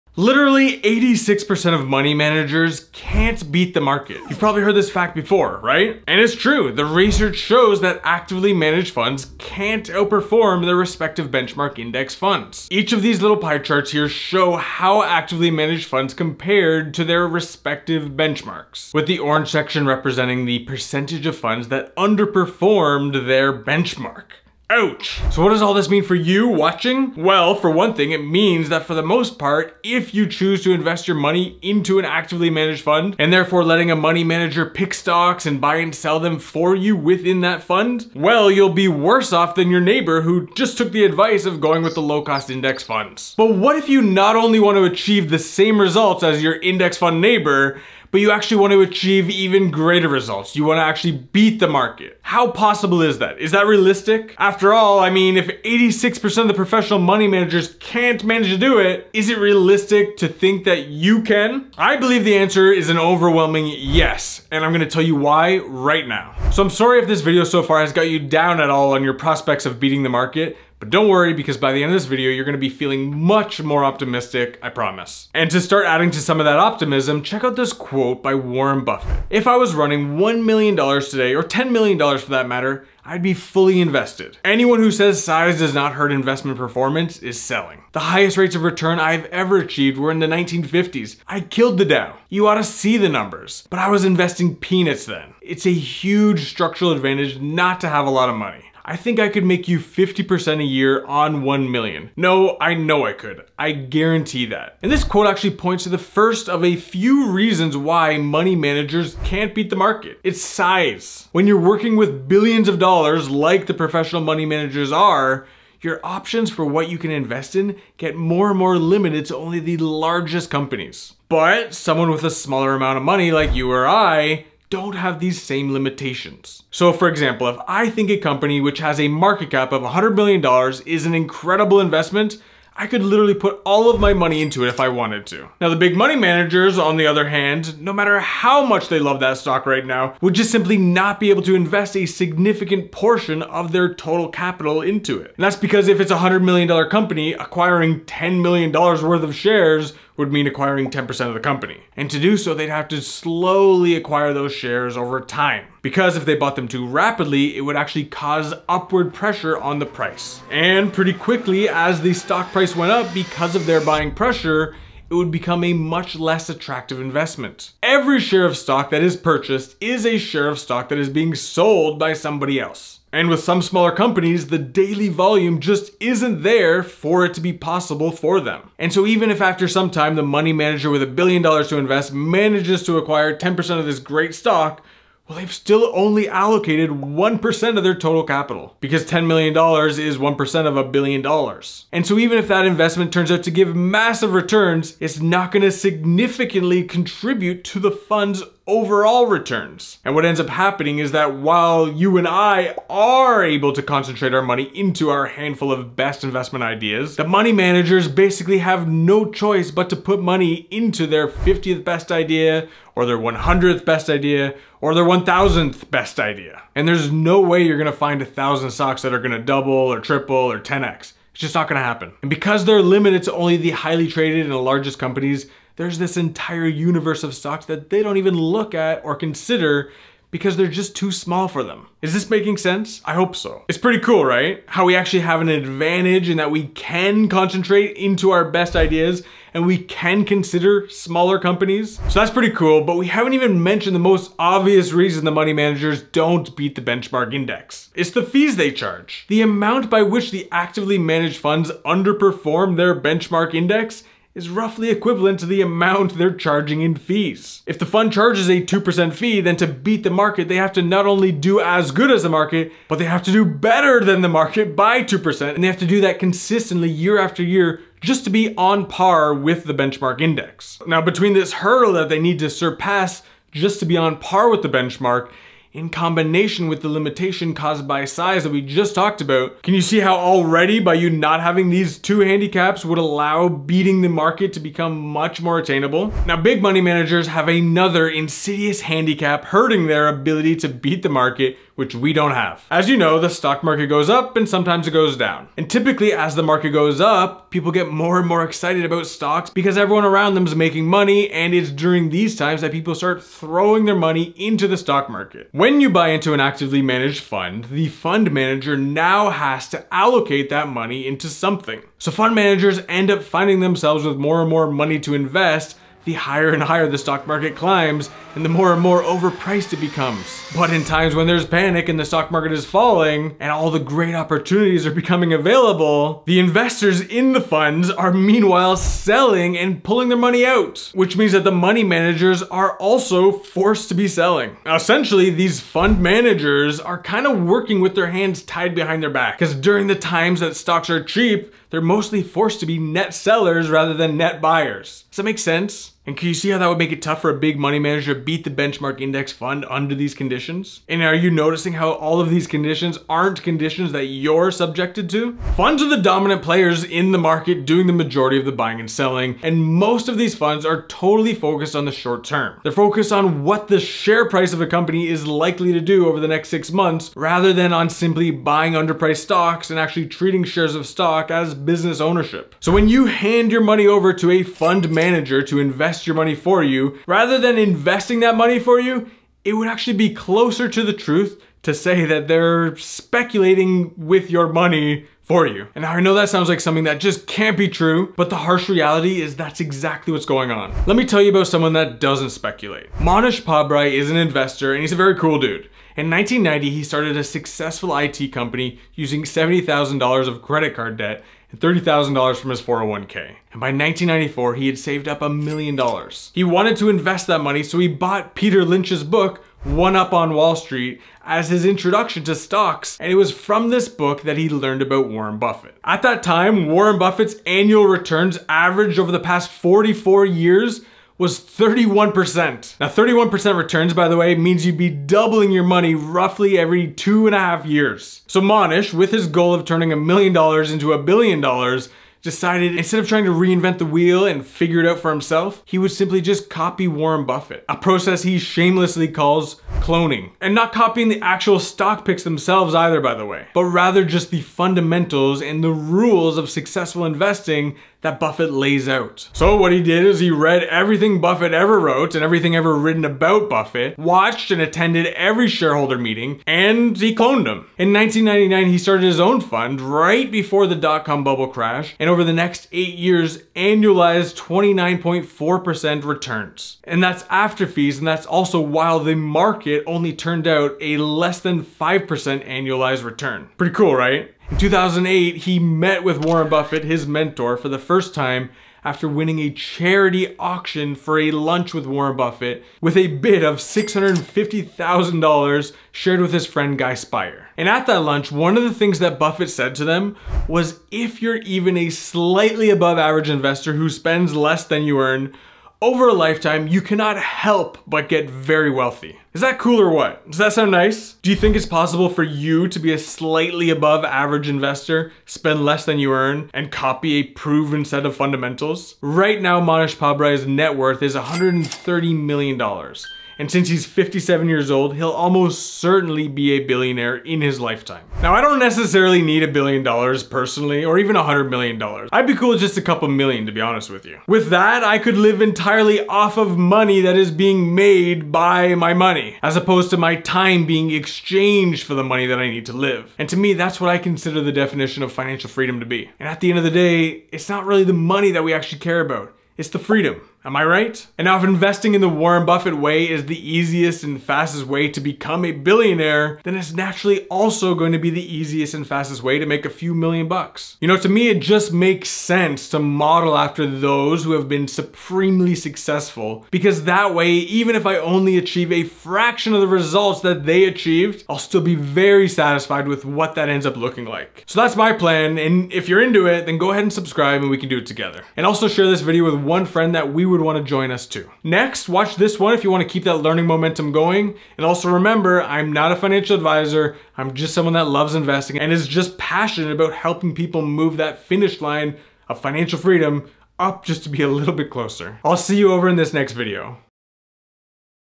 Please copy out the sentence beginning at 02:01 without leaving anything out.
But someone with a smaller amount of money like you or I don't have these same limitations.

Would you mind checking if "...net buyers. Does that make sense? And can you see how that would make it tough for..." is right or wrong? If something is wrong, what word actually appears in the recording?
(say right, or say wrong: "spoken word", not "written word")
right.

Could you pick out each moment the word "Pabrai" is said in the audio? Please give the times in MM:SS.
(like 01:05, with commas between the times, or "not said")
06:33, 08:29.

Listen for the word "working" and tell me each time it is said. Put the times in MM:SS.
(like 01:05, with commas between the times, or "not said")
01:51, 05:37.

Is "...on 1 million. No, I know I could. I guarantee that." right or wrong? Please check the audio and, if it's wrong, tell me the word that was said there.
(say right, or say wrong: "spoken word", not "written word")
right.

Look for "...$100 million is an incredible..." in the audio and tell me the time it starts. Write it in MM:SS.
02:09.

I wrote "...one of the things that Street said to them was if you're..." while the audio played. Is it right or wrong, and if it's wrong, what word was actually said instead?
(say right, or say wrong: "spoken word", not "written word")
wrong: "Buffett", not "Street".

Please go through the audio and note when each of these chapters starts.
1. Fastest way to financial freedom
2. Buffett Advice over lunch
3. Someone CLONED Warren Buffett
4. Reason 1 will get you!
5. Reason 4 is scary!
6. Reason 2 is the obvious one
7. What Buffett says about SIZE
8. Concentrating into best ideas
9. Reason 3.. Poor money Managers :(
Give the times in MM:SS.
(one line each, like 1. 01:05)
1. 08:37
2. 07:54
3. 06:30
4. 01:44
5. 05:55
6. 04:02
7. 01:06
8. 02:47
9. 04:46.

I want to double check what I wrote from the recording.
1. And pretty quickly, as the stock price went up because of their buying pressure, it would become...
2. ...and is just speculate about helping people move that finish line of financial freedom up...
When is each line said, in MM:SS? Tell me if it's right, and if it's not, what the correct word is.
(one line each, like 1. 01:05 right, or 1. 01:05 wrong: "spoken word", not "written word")
1. 02:40 right
2. 09:38 wrong: "passionate", not "speculate".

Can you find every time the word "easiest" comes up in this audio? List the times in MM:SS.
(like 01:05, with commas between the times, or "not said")
09:03, 09:08.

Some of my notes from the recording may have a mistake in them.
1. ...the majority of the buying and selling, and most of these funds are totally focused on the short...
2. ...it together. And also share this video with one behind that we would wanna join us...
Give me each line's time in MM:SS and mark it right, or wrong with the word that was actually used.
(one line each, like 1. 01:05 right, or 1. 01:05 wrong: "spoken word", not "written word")
1. 05:57 right
2. 09:27 wrong: "friend", not "behind".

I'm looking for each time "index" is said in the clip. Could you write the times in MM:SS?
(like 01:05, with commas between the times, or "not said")
00:11, 00:42, 00:46, 04:07, 04:13, 04:30, 05:48.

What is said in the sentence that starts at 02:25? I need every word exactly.
And that's because if it's a $100 million company, acquiring $10 million worth of shares would mean acquiring 10% of the company.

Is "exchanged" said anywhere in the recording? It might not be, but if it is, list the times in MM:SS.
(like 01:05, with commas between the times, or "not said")
08:50.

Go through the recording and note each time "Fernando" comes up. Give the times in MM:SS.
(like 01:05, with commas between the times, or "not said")
not said.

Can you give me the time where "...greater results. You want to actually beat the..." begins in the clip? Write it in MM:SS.
00:49.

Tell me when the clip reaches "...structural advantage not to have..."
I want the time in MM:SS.
01:36.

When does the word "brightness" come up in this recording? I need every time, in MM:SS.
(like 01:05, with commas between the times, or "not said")
not said.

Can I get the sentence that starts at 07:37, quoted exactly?
In 1999, he started his own fund right before the dot-com bubble crash, and over the next eight years, annualized 29.4% returns.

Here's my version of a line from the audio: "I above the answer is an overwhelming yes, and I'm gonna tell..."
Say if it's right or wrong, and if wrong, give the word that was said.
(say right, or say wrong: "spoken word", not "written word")
wrong: "believe", not "above".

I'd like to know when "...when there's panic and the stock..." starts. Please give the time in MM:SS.
05:21.